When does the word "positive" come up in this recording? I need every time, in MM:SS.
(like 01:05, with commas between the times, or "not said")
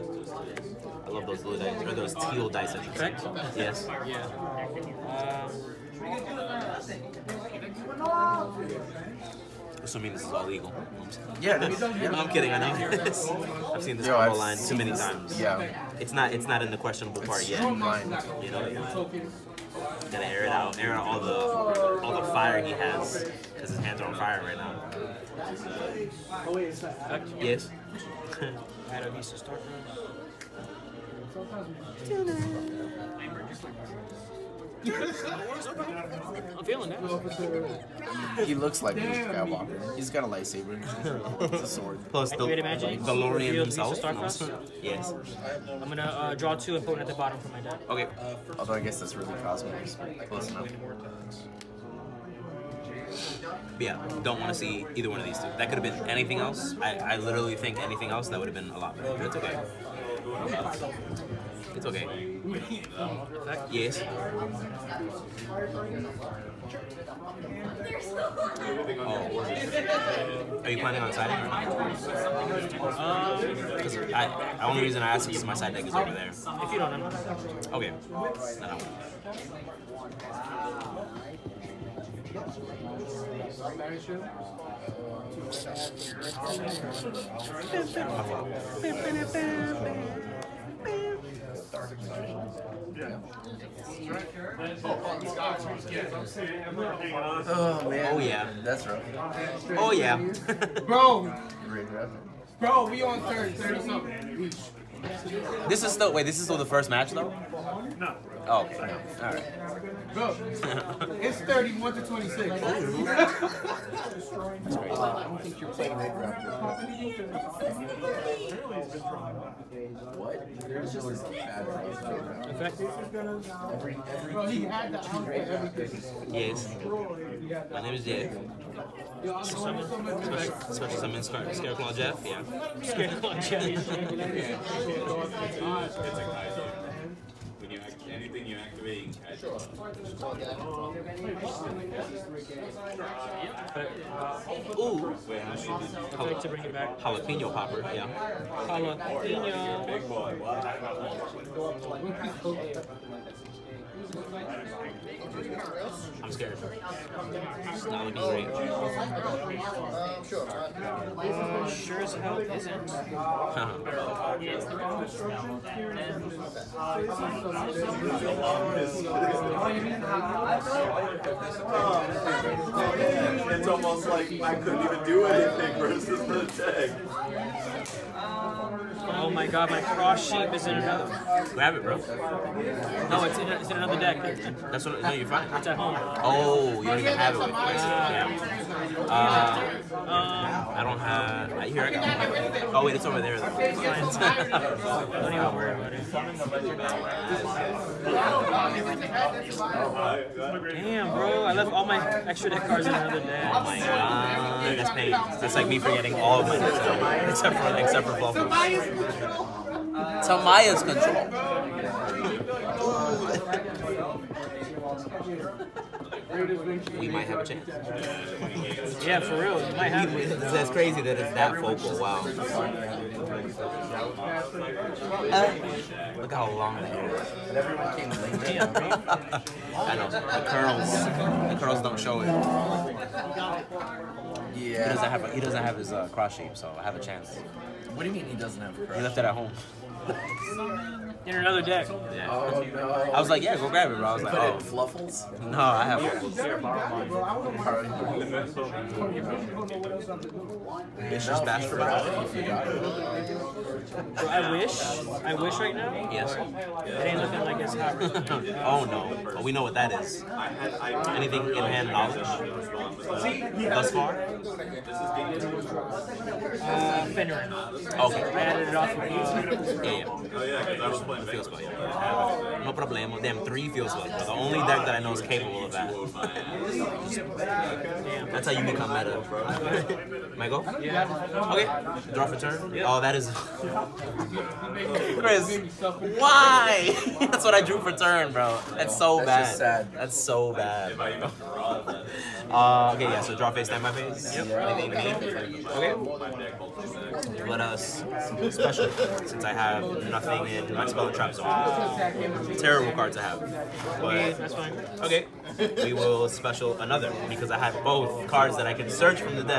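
not said.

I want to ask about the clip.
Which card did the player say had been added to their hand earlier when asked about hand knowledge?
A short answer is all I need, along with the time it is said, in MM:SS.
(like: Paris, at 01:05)
Fenrir, at 04:27.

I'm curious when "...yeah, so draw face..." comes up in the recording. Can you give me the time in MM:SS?
04:53.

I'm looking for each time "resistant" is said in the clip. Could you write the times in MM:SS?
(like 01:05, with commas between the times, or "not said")
not said.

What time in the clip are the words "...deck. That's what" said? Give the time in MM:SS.
03:03.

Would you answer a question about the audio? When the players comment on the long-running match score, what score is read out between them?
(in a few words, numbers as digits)
31 to 26.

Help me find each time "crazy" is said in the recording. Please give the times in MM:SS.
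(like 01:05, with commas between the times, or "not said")
01:52, 03:40.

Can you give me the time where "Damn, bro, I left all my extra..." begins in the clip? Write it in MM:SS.
03:20.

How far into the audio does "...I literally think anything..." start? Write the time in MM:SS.
00:56.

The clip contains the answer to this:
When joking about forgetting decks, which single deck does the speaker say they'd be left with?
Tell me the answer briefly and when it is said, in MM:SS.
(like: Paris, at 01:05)
Volvo, at 03:28.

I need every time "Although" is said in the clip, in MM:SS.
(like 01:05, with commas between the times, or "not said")
00:48.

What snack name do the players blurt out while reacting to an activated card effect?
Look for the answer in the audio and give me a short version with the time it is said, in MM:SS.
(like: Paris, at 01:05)
Jalapeno popper, at 02:26.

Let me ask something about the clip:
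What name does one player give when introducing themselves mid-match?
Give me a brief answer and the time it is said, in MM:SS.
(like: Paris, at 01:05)
Dave, at 02:08.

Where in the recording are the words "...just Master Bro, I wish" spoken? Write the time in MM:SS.
04:11.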